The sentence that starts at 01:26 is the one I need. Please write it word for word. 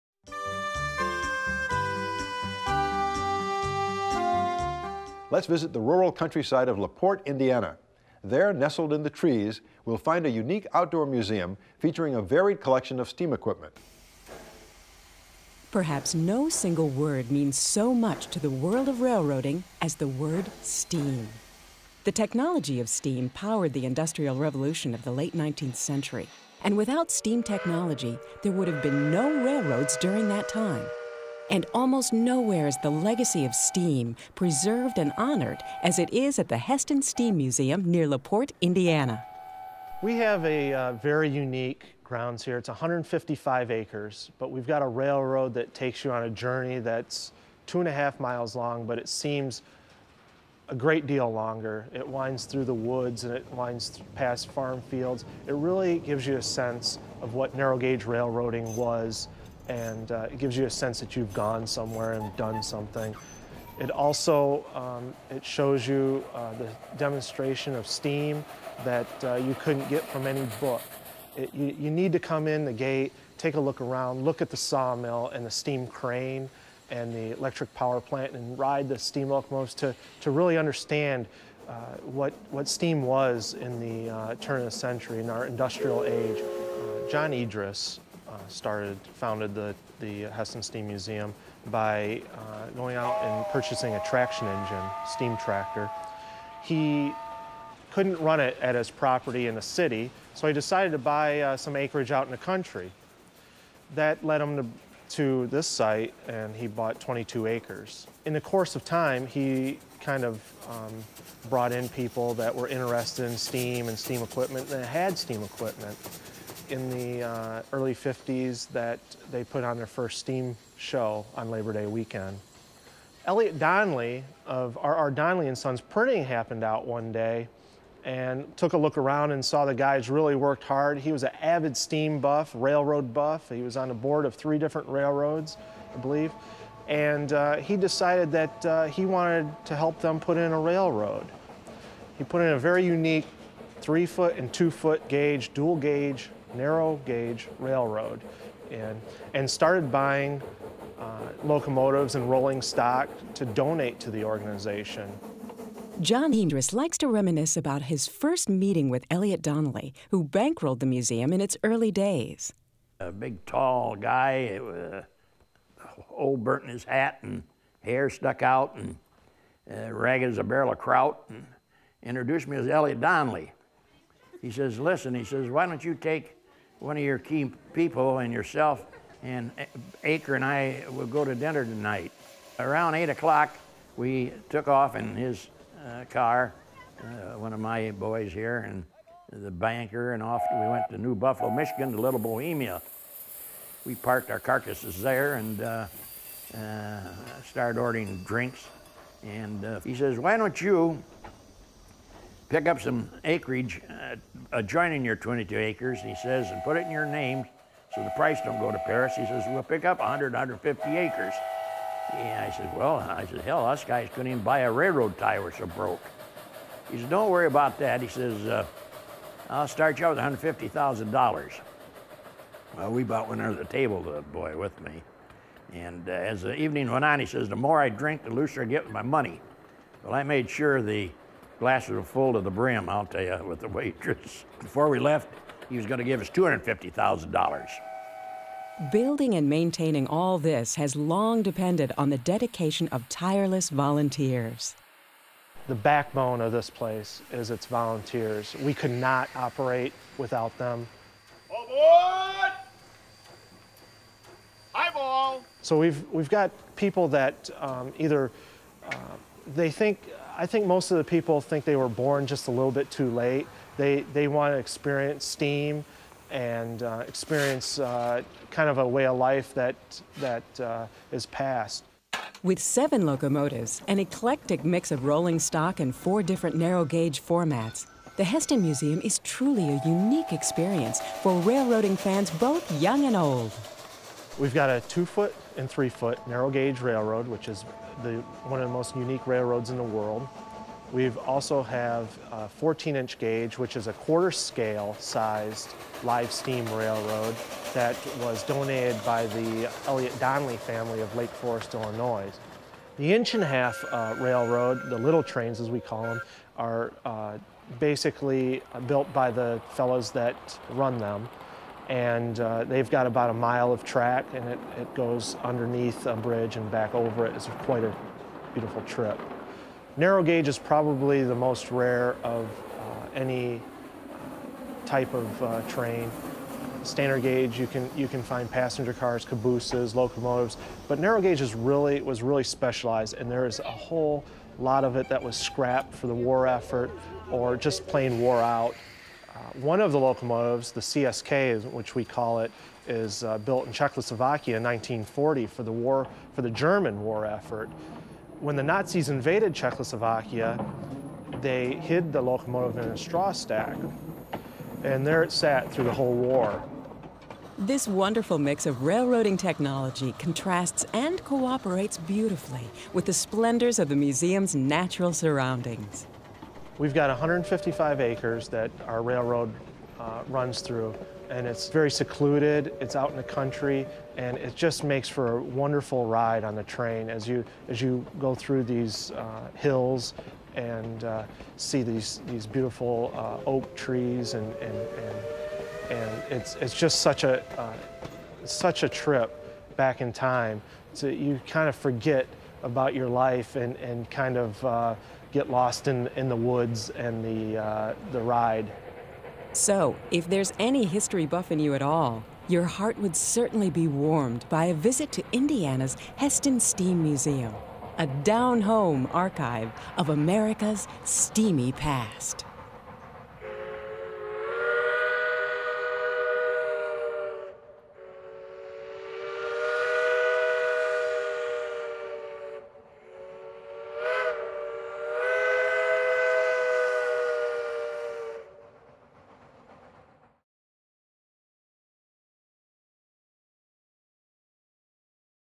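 Uh, John Idris, started, founded the, the Hesston Steam Museum by uh, going out and purchasing a traction engine, steam tractor.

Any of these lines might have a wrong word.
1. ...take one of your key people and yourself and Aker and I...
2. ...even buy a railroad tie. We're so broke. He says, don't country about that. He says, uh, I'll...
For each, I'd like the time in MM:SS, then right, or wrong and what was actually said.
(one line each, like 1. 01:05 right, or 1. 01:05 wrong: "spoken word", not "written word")
1. 02:55 right
2. 03:34 wrong: "worry", not "country".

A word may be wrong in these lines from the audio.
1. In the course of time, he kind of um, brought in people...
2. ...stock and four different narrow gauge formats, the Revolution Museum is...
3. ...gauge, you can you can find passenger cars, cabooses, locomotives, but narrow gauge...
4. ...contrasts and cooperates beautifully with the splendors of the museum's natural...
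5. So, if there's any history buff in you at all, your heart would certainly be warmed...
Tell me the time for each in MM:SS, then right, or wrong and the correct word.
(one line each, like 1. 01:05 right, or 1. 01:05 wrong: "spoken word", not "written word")
1. 01:48 right
2. 04:35 wrong: "Hesston", not "Revolution"
3. 05:27 right
4. 06:00 right
5. 06:39 right.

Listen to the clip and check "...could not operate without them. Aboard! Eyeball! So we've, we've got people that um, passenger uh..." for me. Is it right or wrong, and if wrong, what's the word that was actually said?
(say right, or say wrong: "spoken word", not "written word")
wrong: "either", not "passenger".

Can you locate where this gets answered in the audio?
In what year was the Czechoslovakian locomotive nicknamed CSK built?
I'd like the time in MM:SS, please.
05:44.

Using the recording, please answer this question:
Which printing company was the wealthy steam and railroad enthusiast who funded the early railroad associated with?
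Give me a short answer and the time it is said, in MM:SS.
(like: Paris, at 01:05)
R.R. Donnelley and Sons, at 02:04.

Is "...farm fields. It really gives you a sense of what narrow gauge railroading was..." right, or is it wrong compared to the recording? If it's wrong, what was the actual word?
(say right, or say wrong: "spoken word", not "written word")
right.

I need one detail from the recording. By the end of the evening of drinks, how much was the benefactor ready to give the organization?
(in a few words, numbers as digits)
$250,000.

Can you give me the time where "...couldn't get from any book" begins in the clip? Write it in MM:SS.
01:09.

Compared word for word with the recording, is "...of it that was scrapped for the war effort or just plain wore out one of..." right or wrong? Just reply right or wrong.
right.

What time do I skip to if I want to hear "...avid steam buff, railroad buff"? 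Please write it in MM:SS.
02:11.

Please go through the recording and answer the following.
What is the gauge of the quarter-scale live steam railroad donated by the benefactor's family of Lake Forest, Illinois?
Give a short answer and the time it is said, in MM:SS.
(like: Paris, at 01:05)
14 inch, at 04:52.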